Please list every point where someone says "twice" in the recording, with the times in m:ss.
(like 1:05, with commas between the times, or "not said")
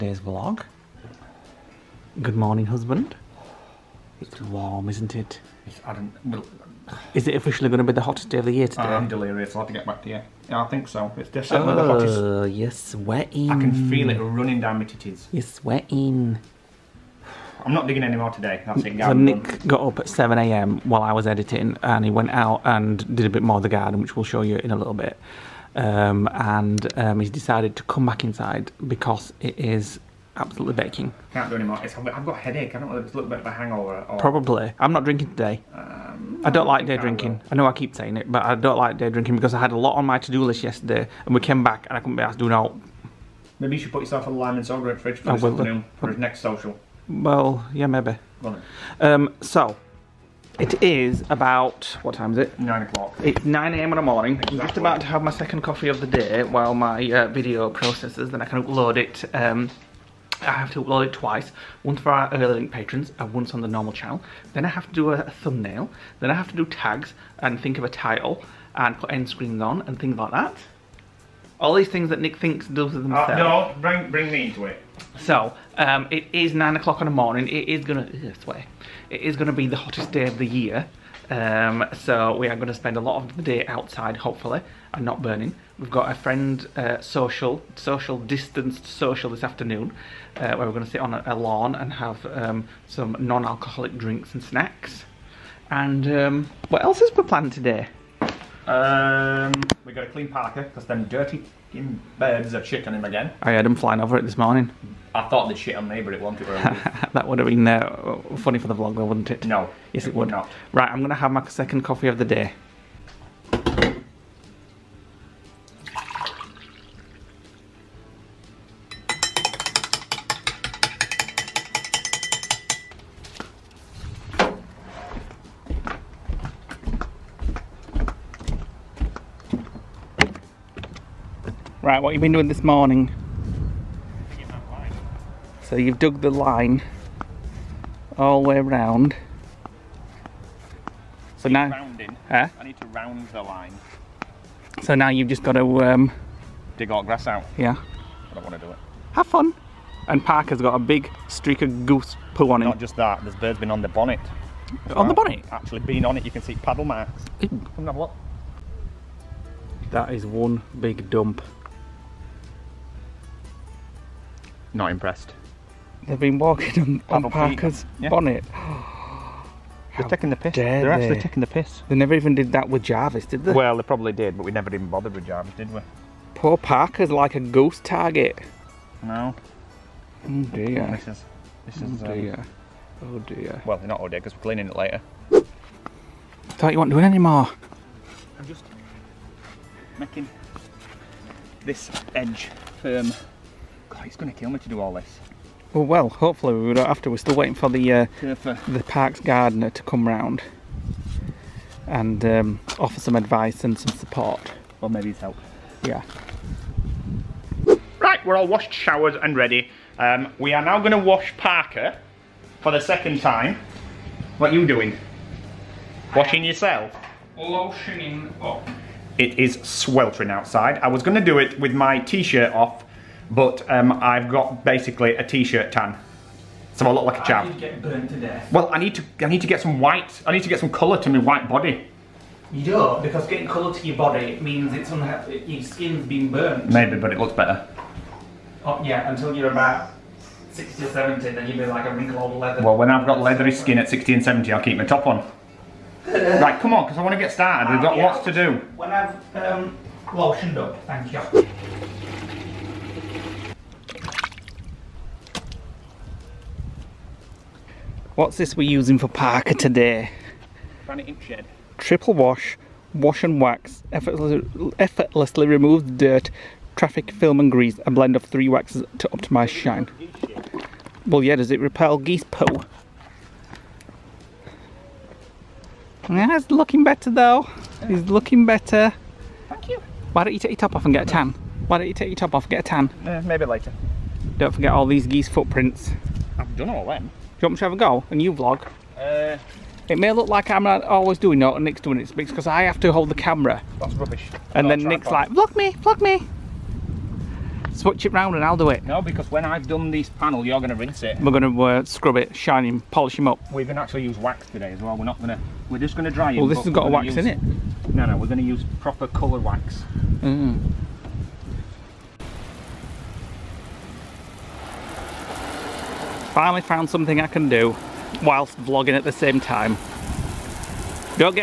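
1:01.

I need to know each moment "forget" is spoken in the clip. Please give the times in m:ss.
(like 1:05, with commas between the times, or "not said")
4:44.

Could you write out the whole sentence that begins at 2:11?
Right, what have you been doing this morning?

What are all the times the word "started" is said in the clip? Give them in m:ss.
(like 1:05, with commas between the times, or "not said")
4:07.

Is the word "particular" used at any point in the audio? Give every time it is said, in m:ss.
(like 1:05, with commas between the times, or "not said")
not said.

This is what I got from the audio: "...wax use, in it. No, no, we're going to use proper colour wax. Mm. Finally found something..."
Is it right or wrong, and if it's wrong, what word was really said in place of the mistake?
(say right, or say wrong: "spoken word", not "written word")
right.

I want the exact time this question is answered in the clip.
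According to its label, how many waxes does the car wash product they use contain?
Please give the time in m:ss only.
4:28.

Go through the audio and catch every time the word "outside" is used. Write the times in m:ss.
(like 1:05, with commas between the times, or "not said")
1:23, 3:40.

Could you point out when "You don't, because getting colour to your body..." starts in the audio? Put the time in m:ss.
3:52.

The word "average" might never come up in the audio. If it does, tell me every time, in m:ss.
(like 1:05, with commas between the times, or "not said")
not said.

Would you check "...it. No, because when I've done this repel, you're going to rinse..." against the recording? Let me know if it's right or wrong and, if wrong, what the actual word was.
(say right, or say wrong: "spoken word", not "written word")
wrong: "panel", not "repel".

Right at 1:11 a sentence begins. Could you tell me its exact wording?
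All these things that Nick thinks does with himself.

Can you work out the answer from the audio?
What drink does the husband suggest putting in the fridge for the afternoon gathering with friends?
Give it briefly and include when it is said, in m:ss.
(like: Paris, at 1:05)
lime and soda, at 0:44.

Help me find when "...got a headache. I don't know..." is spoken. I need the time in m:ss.
0:32.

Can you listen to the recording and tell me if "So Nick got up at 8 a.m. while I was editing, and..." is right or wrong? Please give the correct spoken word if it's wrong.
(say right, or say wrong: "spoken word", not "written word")
wrong: "7", not "8".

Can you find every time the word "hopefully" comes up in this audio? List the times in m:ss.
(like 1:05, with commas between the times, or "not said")
1:24, 3:16.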